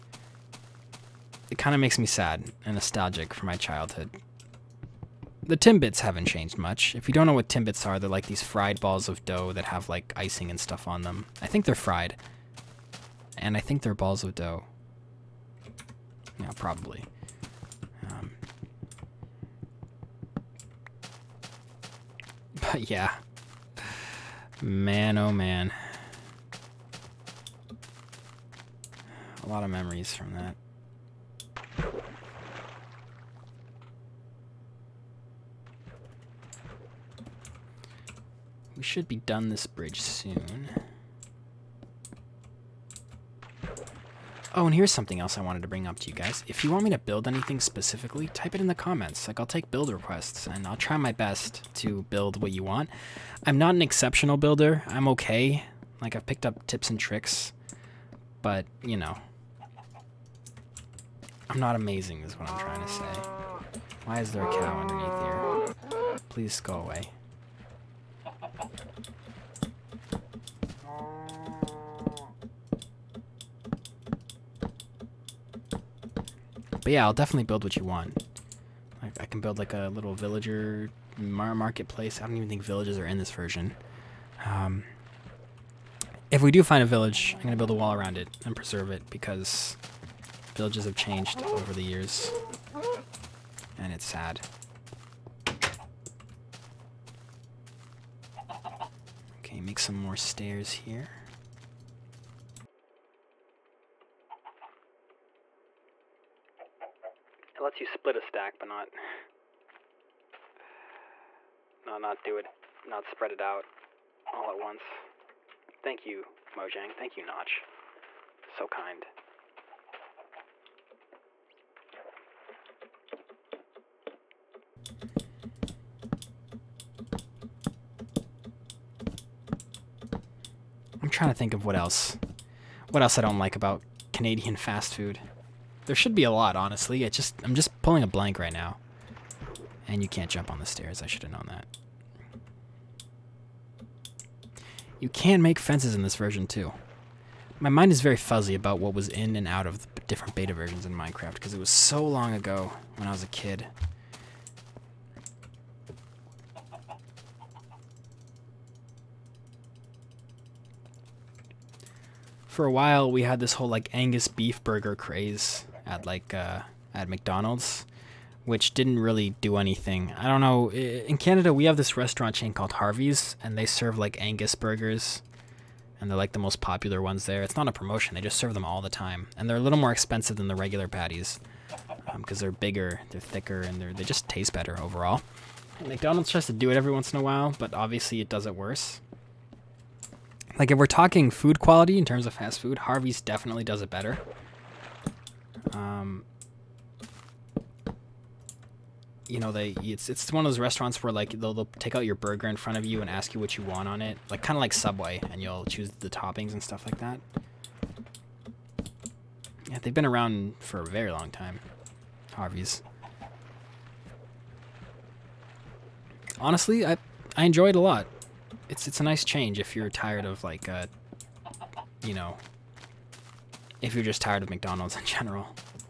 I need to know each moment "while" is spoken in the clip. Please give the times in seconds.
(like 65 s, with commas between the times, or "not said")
162 s, 187 s.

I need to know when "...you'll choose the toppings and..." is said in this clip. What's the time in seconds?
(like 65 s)
205 s.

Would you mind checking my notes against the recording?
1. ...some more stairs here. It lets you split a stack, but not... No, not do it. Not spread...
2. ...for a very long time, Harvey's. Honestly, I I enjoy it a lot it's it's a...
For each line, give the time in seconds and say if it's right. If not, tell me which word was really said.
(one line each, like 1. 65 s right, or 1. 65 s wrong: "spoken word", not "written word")
1. 99 s right
2. 210 s right.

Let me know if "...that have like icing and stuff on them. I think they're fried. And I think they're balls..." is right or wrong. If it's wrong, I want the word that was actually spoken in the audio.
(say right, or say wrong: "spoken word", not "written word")
right.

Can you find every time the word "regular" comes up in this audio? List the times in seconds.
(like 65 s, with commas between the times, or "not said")
180 s.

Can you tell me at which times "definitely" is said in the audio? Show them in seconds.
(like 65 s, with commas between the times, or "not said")
77 s, 193 s.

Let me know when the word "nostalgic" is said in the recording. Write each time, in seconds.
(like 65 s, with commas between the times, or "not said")
2 s.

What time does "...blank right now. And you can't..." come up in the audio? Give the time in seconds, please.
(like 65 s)
138 s.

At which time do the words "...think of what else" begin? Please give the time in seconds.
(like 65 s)
131 s.